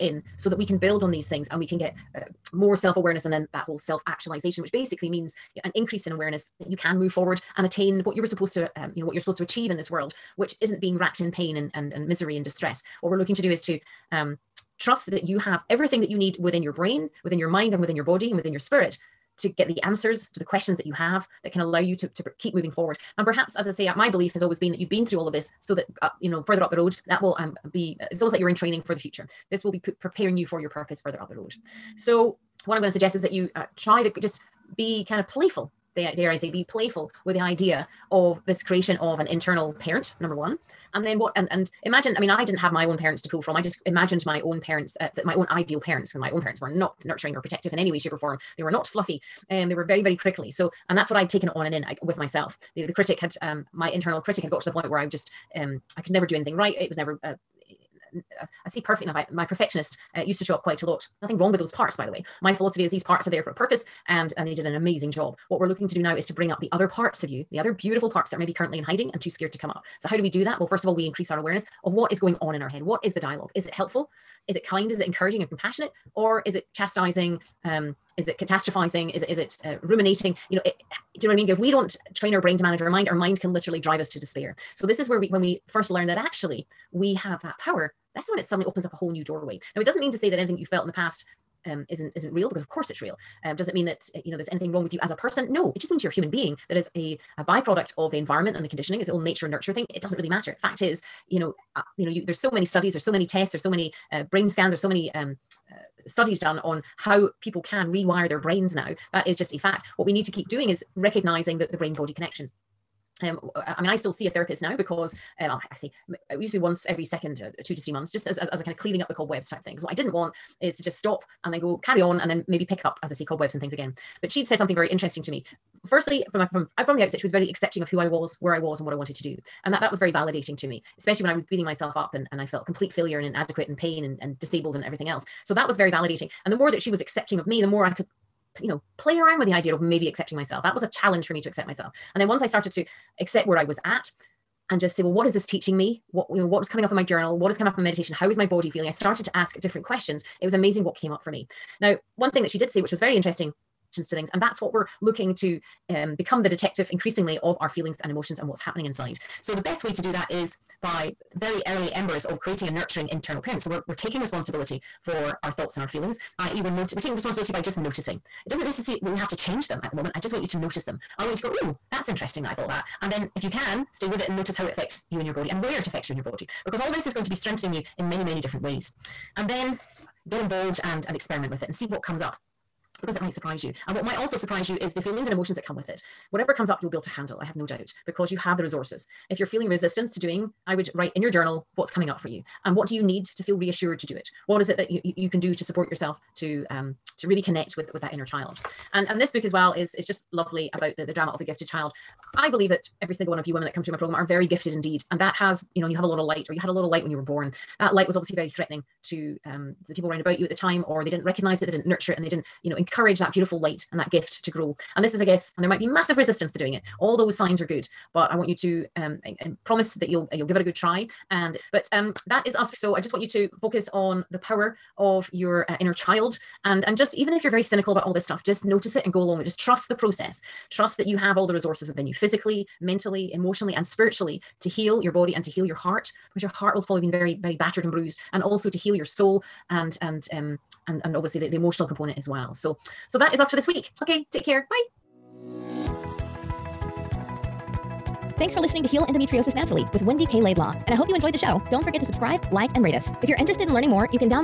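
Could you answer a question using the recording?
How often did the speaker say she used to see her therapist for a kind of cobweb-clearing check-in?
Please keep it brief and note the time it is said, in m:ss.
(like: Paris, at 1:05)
Every 2 to 3 months, at 1:57.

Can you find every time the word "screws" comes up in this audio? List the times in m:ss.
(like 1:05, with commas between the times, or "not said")
not said.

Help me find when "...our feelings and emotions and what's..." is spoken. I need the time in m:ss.
2:37.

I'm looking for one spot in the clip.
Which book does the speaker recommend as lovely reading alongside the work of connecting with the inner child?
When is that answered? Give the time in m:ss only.
3:21.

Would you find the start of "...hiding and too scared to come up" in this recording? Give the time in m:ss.
1:08.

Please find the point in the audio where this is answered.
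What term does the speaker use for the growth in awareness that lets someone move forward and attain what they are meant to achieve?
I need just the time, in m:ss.
0:03.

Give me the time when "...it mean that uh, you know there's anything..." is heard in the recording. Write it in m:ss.
1:33.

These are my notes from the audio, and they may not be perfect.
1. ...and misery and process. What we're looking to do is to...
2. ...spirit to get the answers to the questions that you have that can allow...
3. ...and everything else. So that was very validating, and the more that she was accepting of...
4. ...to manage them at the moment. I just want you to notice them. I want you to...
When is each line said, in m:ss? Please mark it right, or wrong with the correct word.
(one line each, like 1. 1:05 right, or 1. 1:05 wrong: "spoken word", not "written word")
1. 0:11 wrong: "distress", not "process"
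2. 0:18 right
3. 2:14 right
4. 2:49 wrong: "change", not "manage".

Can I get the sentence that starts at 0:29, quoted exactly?
This will be preparing you for your purpose further up the road.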